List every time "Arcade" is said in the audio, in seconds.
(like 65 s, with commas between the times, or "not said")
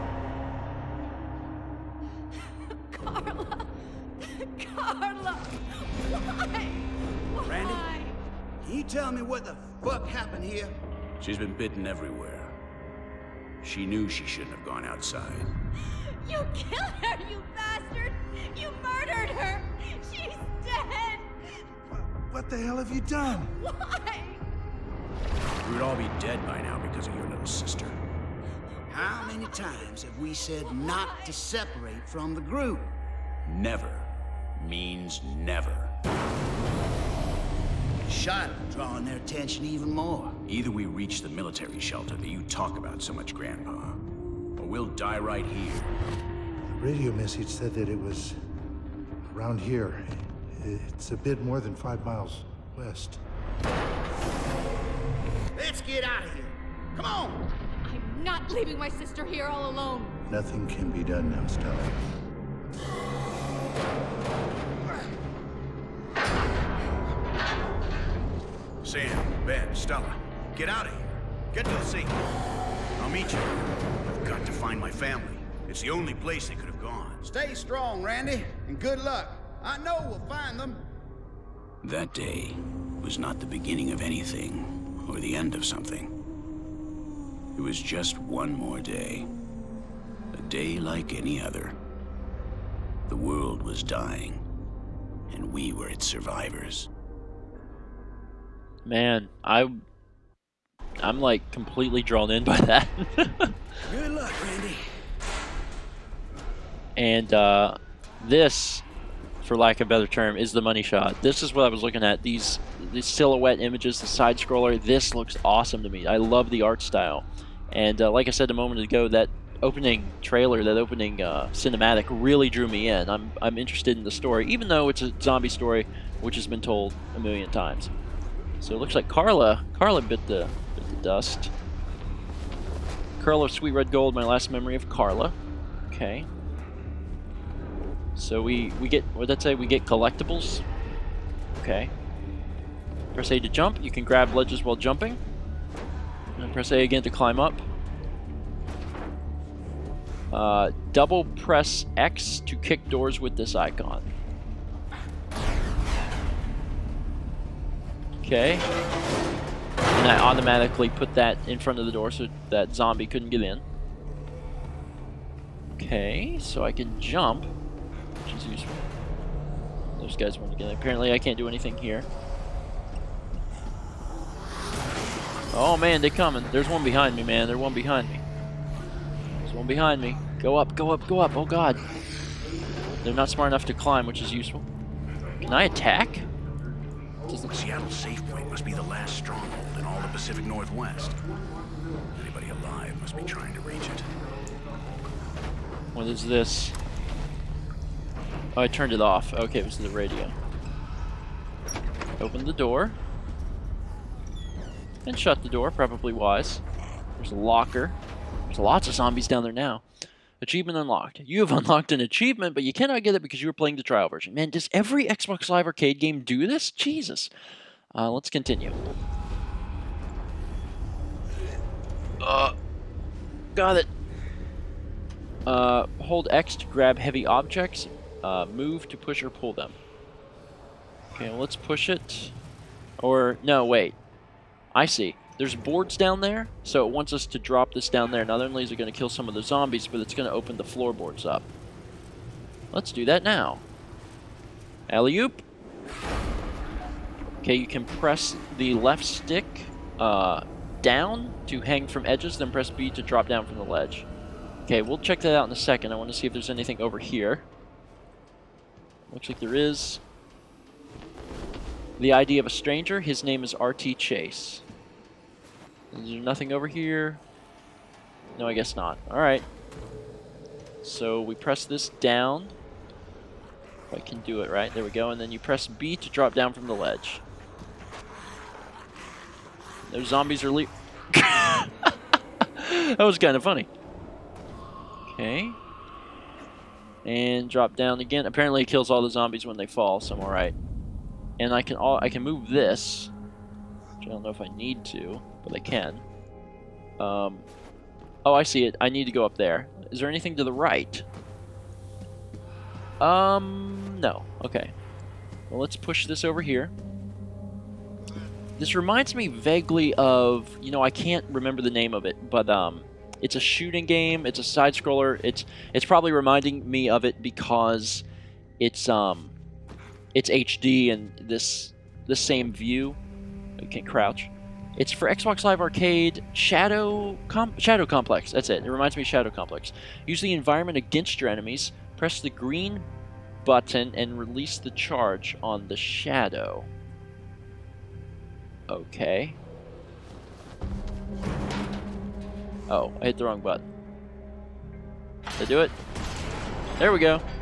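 215 s, 325 s.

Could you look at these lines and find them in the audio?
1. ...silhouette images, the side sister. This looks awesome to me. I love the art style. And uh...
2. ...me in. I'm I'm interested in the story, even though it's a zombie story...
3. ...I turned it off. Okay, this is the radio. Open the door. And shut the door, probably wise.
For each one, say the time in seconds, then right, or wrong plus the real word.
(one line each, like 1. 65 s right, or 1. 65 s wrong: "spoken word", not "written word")
1. 113 s wrong: "scroller", not "sister"
2. 122 s right
3. 198 s right.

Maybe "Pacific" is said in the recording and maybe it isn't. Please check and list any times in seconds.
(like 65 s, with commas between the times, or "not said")
190 s.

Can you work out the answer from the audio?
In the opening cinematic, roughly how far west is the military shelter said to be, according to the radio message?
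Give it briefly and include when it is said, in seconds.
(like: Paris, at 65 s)
5 miles, at 51 s.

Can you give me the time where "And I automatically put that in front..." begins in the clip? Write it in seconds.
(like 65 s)
159 s.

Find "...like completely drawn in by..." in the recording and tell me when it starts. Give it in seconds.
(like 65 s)
101 s.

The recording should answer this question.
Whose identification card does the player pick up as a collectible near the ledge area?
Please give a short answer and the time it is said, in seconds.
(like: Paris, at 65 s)
R.T. Chase, at 263 s.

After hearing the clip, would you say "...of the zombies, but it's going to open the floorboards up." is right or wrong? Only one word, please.
right.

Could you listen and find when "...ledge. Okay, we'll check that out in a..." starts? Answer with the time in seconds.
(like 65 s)
253 s.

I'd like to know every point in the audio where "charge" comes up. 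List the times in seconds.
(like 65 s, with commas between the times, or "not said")
334 s.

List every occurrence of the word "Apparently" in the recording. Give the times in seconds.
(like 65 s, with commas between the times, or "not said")
170 s, 288 s.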